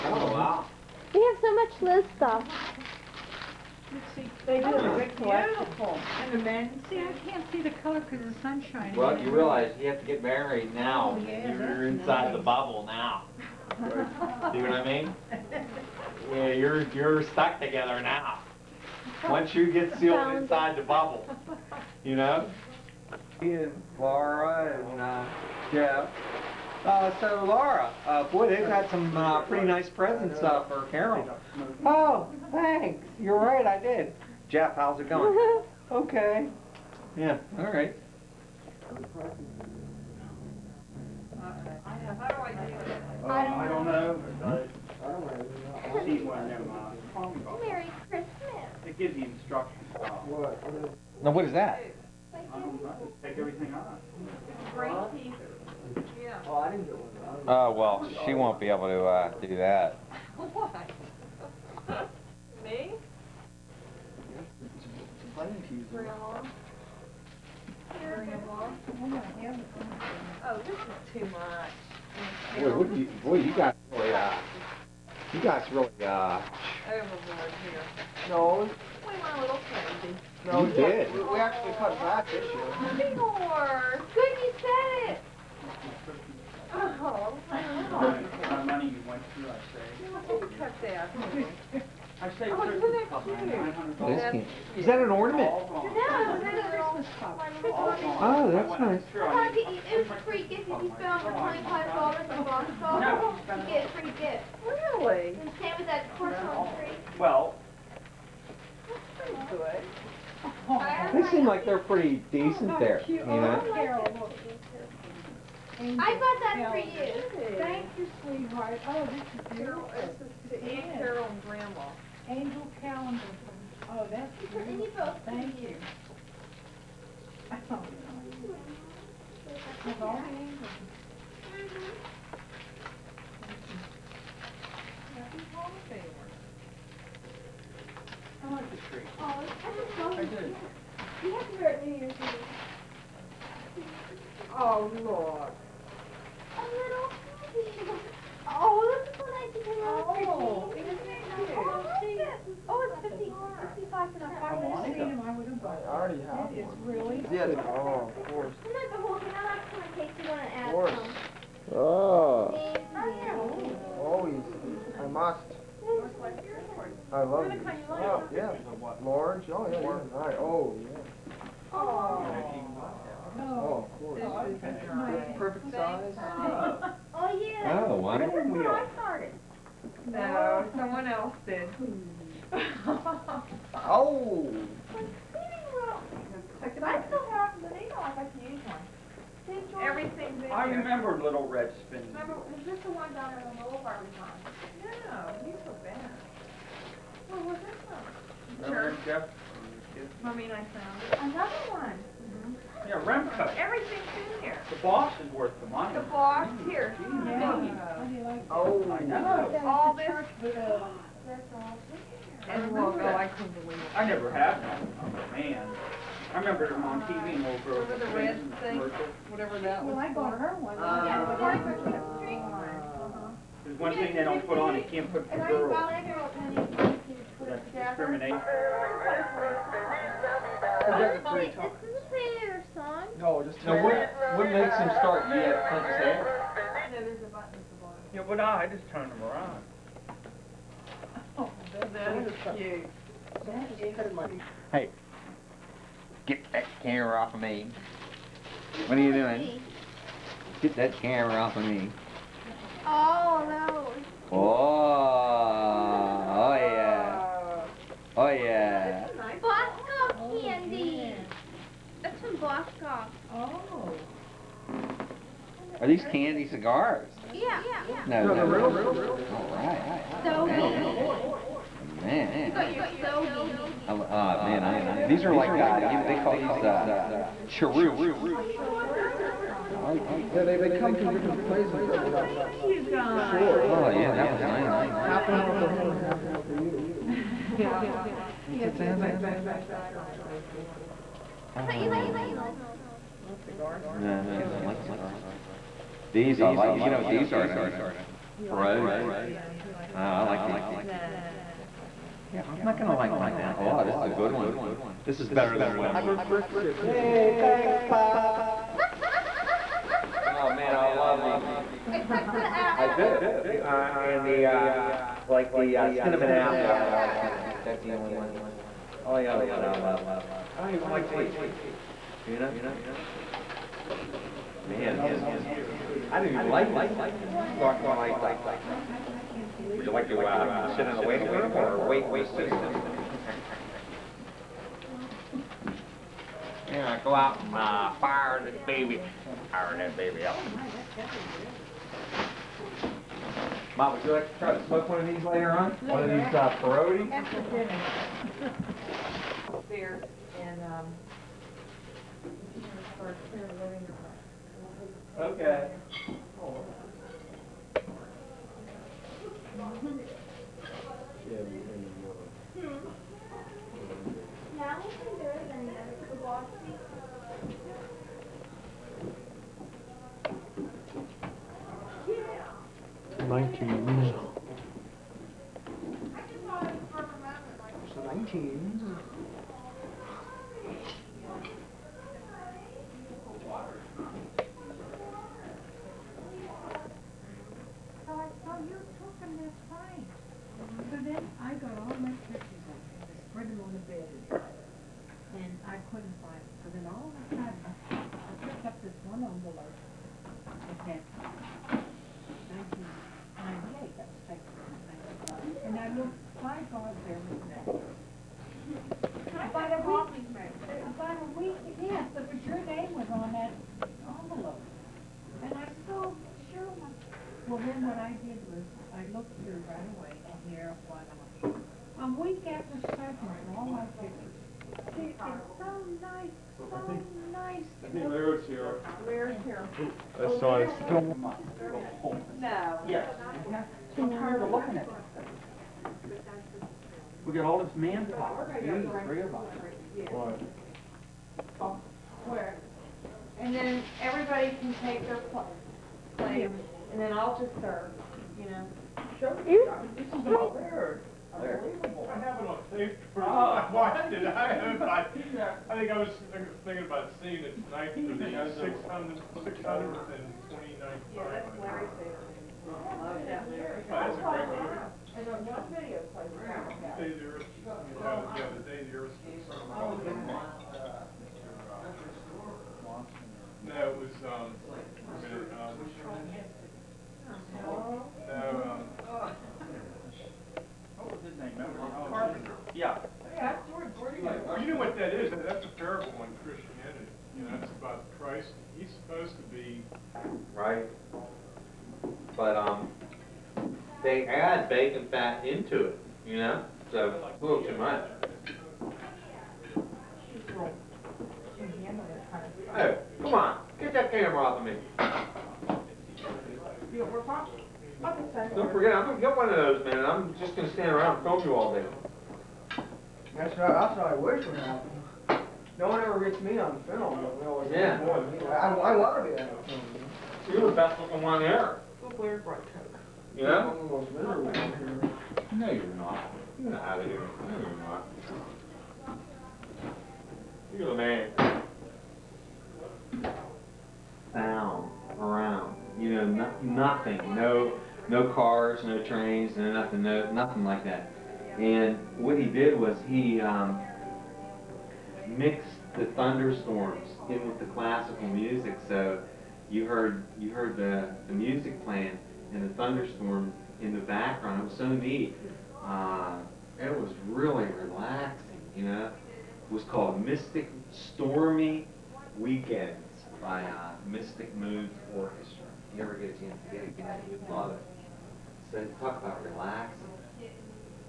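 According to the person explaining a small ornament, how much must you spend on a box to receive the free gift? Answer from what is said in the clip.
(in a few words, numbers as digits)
$25.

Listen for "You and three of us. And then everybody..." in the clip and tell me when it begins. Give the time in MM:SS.
07:18.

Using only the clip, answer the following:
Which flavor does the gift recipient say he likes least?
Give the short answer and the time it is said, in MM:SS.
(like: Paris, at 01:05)
Cinnamon apple, at 05:16.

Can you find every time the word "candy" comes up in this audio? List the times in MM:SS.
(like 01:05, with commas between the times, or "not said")
04:26.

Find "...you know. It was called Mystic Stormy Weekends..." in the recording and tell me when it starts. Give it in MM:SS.
09:18.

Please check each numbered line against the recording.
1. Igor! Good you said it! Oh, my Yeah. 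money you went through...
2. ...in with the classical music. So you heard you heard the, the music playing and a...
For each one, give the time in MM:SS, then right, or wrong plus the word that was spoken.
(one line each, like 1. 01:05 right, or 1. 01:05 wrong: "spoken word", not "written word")
1. 01:23 wrong: "God", not "Yeah"
2. 09:07 right.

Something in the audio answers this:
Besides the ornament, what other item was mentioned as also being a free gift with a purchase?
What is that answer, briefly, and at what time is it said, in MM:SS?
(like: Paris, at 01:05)
Porcelain tree, at 01:46.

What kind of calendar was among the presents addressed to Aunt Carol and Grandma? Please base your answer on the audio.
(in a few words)
Angel calendar.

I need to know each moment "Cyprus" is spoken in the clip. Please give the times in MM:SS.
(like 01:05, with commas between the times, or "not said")
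07:02.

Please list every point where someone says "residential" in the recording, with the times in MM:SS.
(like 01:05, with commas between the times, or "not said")
not said.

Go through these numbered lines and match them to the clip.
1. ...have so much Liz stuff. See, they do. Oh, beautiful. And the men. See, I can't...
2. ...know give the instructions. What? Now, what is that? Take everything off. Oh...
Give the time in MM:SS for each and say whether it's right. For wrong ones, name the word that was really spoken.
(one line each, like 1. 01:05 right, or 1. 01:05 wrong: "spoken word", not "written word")
1. 00:01 right
2. 00:47 right.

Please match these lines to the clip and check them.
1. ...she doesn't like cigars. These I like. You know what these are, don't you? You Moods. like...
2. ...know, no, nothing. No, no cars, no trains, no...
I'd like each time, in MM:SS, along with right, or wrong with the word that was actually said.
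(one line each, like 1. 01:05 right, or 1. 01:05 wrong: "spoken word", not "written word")
1. 04:54 wrong: "Brogues", not "Moods"
2. 08:56 right.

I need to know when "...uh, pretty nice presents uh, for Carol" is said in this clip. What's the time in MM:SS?
00:29.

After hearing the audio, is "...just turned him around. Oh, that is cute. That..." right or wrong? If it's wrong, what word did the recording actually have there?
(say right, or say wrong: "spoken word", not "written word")
right.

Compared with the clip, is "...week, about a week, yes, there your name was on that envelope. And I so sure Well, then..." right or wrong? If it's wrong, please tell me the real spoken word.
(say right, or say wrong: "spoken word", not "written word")
right.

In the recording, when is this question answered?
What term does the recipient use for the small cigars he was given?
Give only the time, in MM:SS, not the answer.
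04:37.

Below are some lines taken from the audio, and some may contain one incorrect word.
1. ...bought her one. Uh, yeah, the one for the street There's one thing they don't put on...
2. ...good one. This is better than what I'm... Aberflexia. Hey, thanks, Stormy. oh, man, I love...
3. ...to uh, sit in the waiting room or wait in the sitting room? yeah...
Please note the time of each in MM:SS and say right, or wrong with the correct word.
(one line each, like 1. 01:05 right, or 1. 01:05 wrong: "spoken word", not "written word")
1. 03:40 right
2. 05:04 wrong: "Pop", not "Stormy"
3. 05:30 right.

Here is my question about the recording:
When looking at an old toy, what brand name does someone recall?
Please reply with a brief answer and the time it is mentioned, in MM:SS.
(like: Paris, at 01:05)
Remco, at 03:23.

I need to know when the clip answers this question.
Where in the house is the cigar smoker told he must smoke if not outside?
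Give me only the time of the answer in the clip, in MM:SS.
04:50.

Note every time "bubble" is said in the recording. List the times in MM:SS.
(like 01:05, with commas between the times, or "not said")
00:12, 00:20.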